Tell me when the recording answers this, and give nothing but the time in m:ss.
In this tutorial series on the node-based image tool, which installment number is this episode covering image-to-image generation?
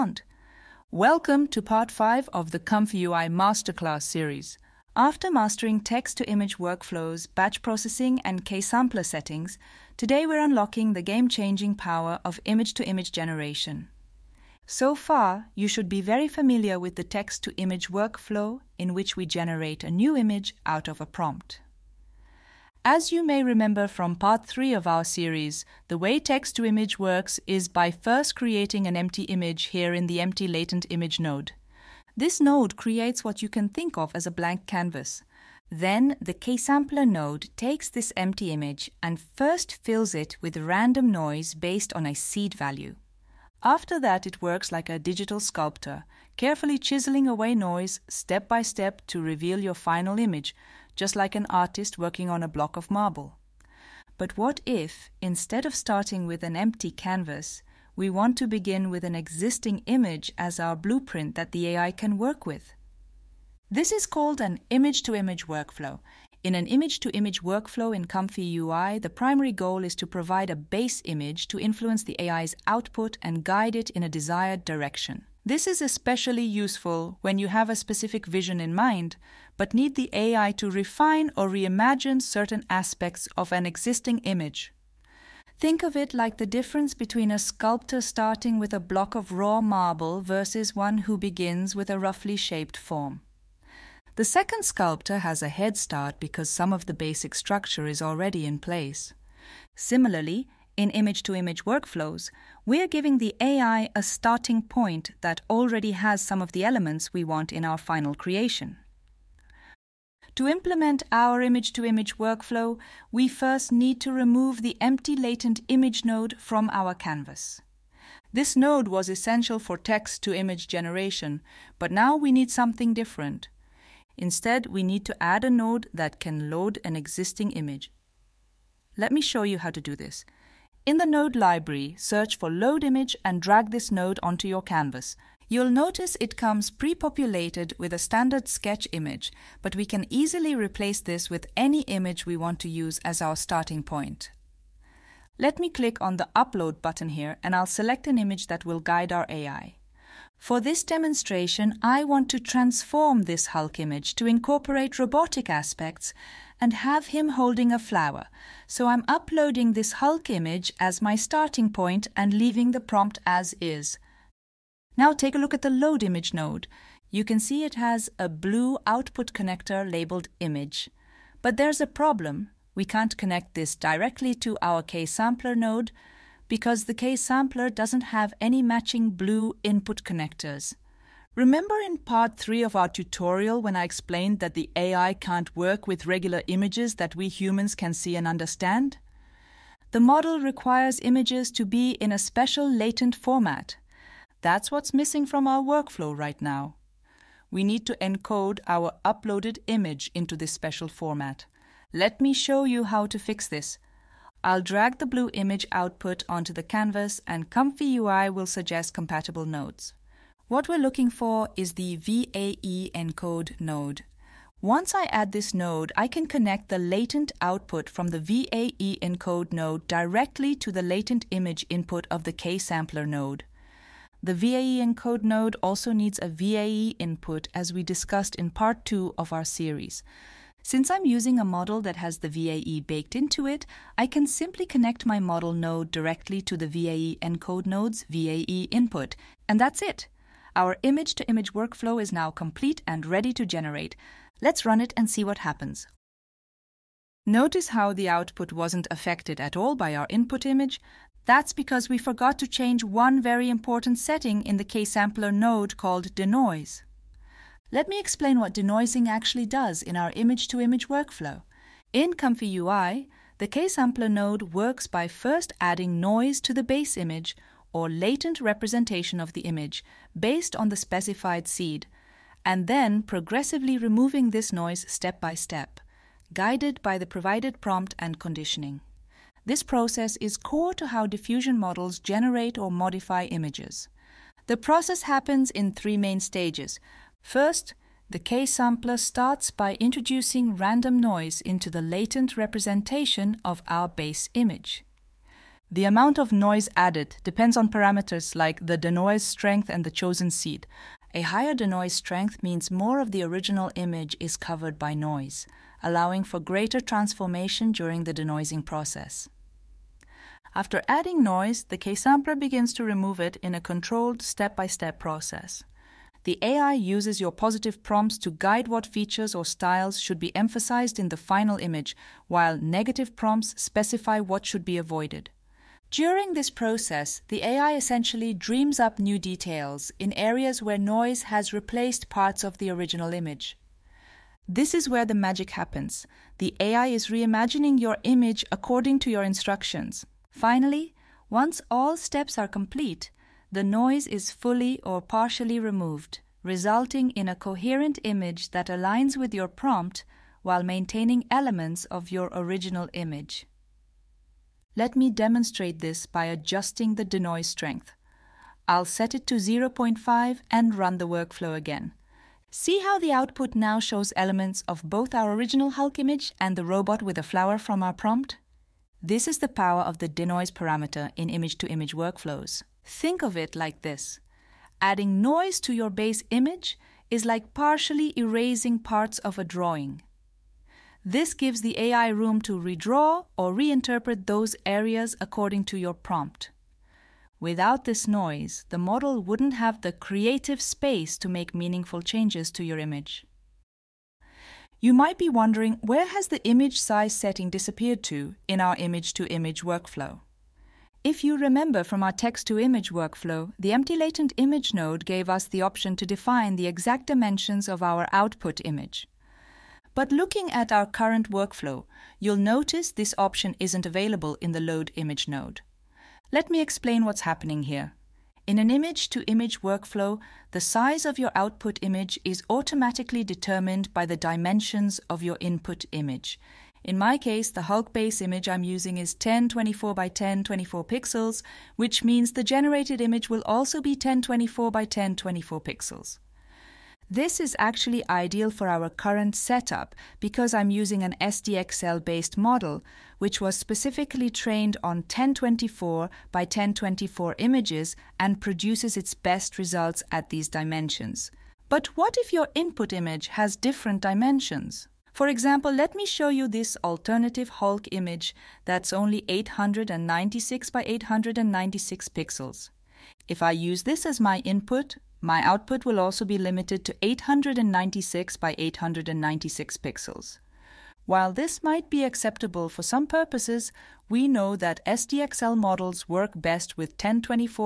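0:01.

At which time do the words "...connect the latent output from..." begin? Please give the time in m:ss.
3:36.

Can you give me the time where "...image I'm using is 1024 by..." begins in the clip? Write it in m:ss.
7:08.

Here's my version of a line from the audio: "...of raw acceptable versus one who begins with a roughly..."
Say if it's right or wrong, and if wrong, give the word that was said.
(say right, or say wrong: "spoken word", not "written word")
wrong: "marble", not "acceptable".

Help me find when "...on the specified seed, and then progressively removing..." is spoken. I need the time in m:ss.
4:30.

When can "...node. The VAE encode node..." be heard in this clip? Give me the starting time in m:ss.
3:43.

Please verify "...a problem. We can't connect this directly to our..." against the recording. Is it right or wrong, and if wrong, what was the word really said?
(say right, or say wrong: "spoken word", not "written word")
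right.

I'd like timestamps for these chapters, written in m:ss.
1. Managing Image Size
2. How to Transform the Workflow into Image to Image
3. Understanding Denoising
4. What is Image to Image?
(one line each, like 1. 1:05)
1. 6:33
2. 1:49
3. 4:06
4. 0:22.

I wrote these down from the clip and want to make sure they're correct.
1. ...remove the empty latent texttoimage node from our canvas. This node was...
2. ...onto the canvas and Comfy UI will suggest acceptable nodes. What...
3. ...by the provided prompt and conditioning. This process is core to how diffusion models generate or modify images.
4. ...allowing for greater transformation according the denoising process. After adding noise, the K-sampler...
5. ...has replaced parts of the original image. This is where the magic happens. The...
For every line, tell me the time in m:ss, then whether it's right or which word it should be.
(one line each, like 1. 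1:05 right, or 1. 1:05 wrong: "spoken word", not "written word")
1. 1:54 wrong: "image", not "texttoimage"
2. 3:26 wrong: "compatible", not "acceptable"
3. 4:36 right
4. 5:05 wrong: "during", not "according"
5. 5:31 right.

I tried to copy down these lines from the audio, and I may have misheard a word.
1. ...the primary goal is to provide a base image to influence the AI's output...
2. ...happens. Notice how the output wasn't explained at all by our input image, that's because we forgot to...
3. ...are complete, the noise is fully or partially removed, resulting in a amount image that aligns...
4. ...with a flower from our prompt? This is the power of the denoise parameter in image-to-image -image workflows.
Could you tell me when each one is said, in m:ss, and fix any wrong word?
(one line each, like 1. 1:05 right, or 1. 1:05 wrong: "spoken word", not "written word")
1. 1:08 right
2. 4:05 wrong: "affected", not "explained"
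3. 5:42 wrong: "coherent", not "amount"
4. 6:07 right.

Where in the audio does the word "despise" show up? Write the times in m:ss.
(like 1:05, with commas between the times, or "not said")
not said.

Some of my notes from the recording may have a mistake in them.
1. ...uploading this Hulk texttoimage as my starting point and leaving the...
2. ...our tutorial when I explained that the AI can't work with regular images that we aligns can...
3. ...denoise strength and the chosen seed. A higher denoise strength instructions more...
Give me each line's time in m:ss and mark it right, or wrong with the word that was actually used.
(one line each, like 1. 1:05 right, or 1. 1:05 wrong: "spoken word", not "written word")
1. 2:39 wrong: "image", not "texttoimage"
2. 3:02 wrong: "humans", not "aligns"
3. 4:58 wrong: "means", not "instructions".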